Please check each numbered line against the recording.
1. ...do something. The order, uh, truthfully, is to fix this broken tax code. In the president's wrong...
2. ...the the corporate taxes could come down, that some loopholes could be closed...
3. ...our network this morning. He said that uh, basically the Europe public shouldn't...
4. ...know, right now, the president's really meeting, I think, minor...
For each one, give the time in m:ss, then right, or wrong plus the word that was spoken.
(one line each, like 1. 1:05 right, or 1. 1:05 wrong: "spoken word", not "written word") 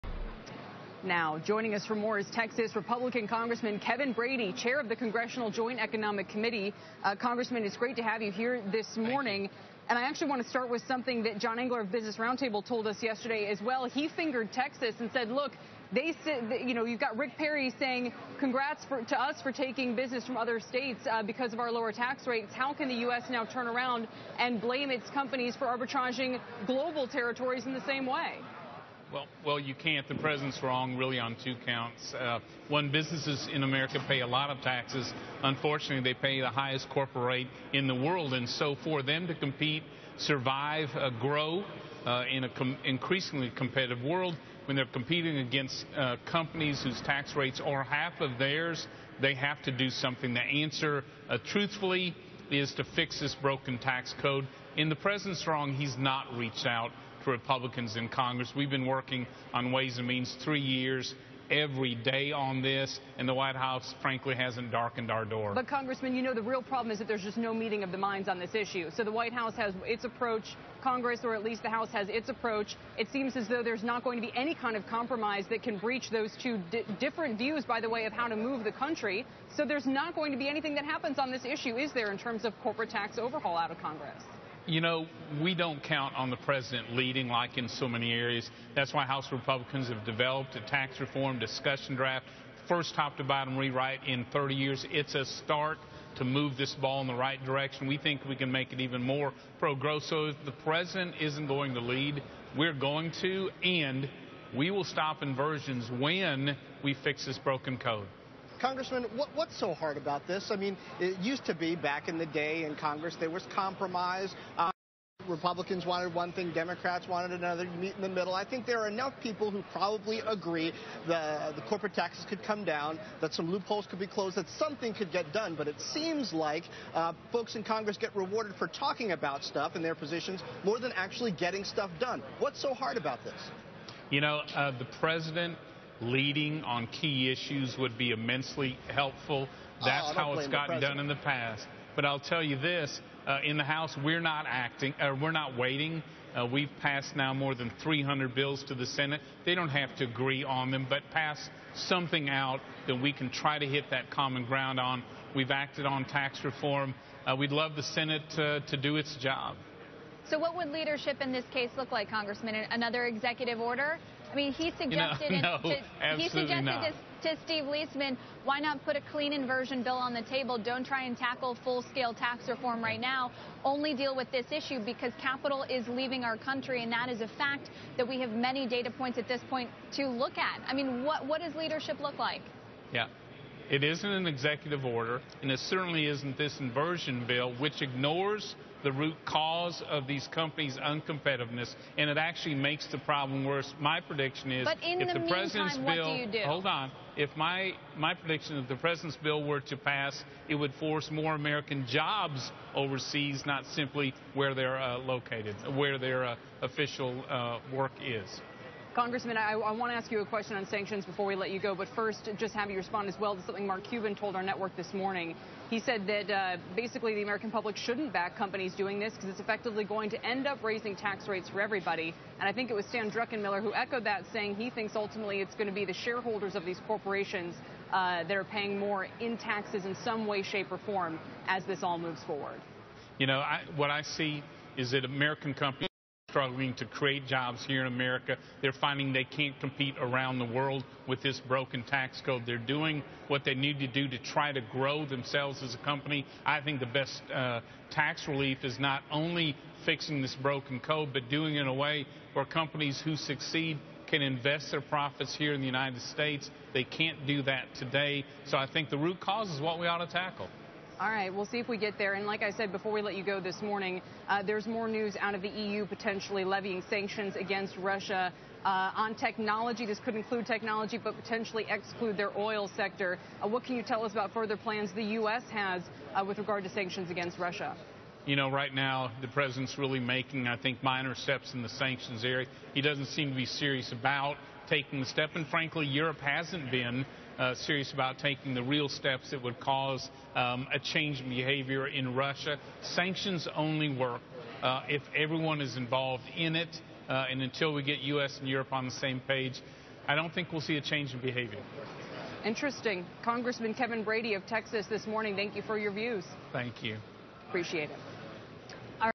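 1. 0:49 wrong: "answer", not "order"
2. 2:01 right
3. 3:34 wrong: "American", not "Europe"
4. 4:38 wrong: "making", not "meeting".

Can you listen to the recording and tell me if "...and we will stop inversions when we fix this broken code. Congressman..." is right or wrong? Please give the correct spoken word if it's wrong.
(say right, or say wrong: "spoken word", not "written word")
right.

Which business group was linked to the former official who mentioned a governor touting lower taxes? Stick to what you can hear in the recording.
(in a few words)
Business Roundtable.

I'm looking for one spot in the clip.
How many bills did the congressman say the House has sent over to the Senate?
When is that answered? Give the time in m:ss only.
2:27.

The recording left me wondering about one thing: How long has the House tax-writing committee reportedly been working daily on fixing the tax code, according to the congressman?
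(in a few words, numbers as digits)
3 years.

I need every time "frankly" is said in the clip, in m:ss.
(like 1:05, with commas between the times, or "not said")
1:04, 4:45.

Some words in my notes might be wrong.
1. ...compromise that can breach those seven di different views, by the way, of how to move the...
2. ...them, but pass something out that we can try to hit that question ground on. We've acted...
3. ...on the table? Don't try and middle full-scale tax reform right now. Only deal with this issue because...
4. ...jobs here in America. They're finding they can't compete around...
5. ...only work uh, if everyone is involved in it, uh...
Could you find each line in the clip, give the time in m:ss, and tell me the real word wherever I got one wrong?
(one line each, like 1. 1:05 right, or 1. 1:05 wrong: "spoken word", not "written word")
1. 1:14 wrong: "two", not "seven"
2. 2:30 wrong: "common", not "question"
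3. 2:49 wrong: "tackle", not "middle"
4. 3:57 right
5. 4:53 right.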